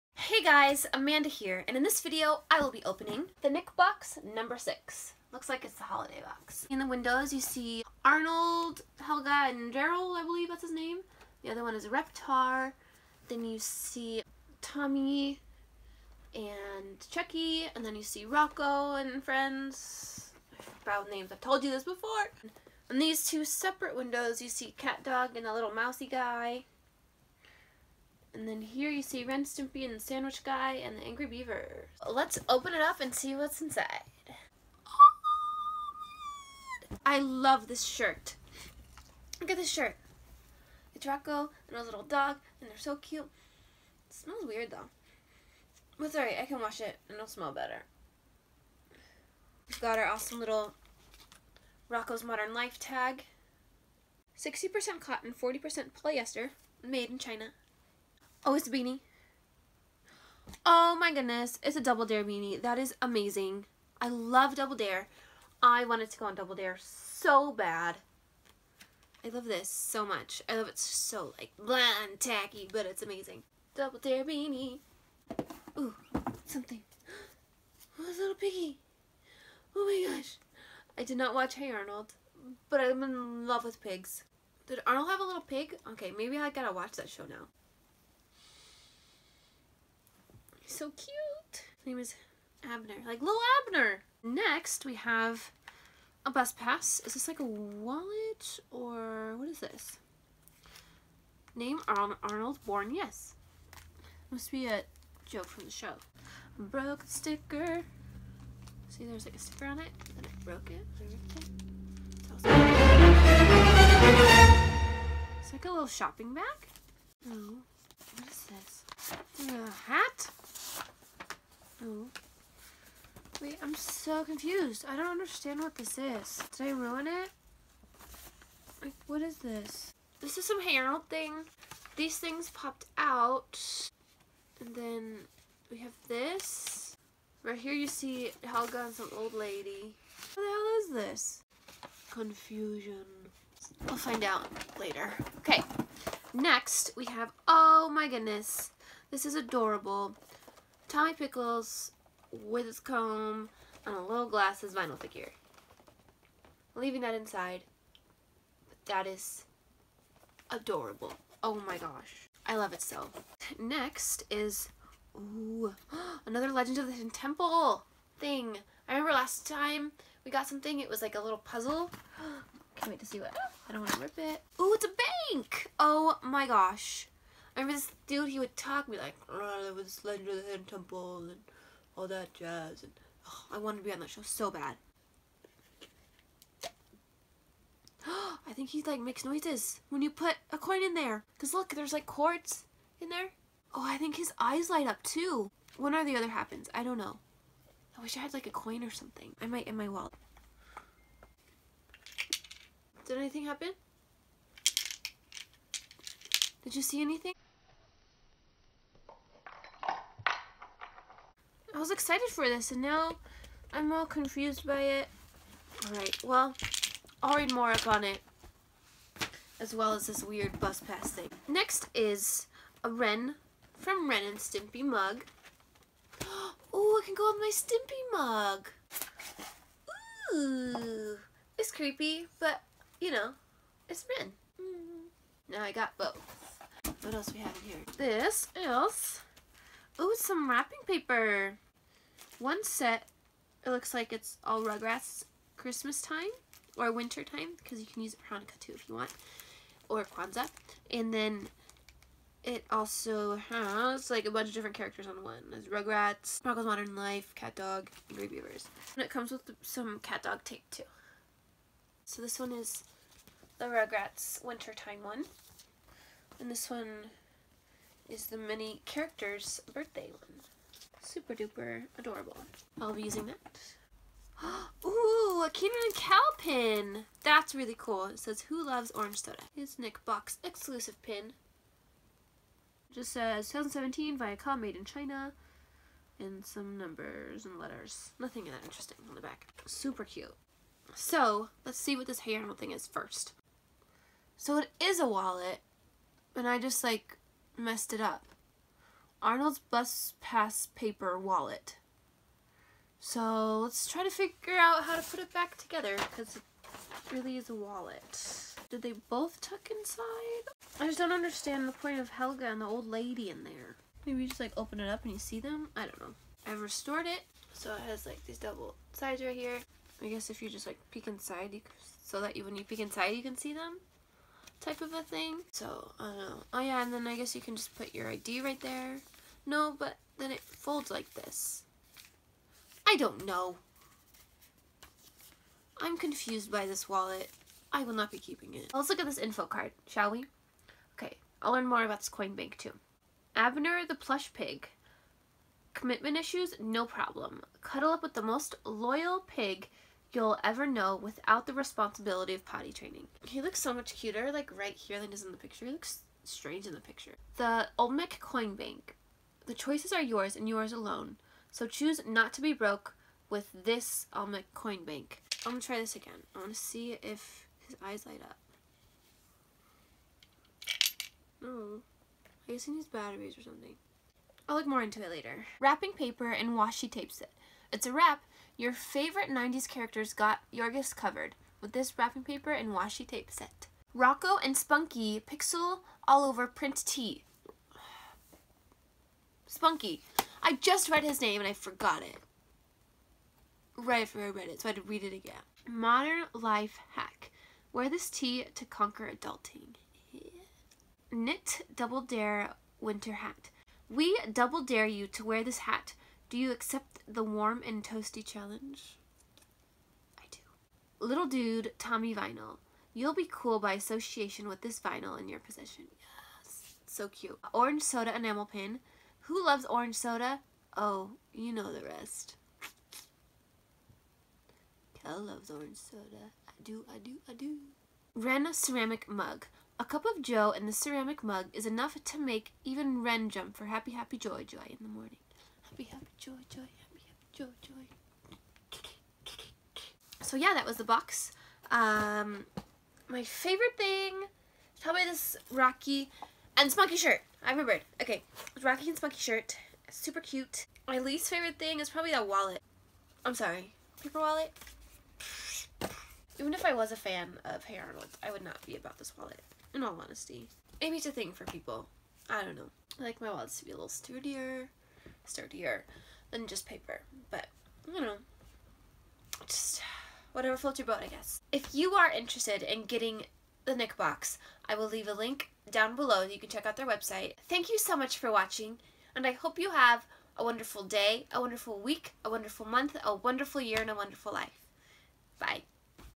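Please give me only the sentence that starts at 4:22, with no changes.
So this one is the Rugrats wintertime one.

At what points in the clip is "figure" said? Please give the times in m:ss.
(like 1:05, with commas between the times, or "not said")
2:34, 5:04.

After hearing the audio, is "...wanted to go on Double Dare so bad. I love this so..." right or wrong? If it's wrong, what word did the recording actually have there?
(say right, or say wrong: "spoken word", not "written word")
right.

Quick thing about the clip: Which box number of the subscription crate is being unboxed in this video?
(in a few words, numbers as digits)
6.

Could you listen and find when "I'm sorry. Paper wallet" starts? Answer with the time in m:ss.
7:33.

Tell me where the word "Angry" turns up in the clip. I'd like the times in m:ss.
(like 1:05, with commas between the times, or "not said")
0:31, 4:18.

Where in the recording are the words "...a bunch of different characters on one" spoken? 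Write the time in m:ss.
4:14.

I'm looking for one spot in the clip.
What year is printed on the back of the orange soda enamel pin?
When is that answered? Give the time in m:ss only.
4:43.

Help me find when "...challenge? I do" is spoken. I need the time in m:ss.
6:48.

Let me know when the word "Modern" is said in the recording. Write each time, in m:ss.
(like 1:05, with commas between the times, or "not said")
0:52, 4:16, 6:35.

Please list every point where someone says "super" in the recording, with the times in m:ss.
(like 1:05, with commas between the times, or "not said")
4:31, 4:49, 7:29.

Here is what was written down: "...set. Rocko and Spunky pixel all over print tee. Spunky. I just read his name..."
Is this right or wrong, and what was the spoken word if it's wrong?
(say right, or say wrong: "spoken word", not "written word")
right.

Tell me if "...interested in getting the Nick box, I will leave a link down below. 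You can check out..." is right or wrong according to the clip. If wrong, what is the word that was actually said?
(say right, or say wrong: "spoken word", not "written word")
right.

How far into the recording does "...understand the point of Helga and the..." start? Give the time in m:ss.
5:11.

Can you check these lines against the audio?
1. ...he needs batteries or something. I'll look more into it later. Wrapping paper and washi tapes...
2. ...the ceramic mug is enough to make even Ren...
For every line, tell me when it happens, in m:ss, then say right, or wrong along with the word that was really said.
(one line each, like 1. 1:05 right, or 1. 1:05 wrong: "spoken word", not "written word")
1. 6:12 right
2. 7:10 right.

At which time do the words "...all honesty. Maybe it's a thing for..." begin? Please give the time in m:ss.
7:39.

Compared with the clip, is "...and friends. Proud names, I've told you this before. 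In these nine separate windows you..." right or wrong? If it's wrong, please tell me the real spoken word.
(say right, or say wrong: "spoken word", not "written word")
wrong: "two", not "nine".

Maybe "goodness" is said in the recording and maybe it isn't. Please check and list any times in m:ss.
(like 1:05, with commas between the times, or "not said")
1:01, 2:28.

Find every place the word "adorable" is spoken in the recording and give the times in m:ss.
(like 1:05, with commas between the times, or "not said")
2:29, 2:40, 4:31.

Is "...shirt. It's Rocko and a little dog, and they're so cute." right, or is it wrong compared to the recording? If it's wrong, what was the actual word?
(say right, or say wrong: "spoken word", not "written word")
right.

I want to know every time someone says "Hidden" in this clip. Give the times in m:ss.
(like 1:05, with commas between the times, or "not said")
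2:46, 3:00.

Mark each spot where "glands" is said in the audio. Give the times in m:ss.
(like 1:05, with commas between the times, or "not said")
not said.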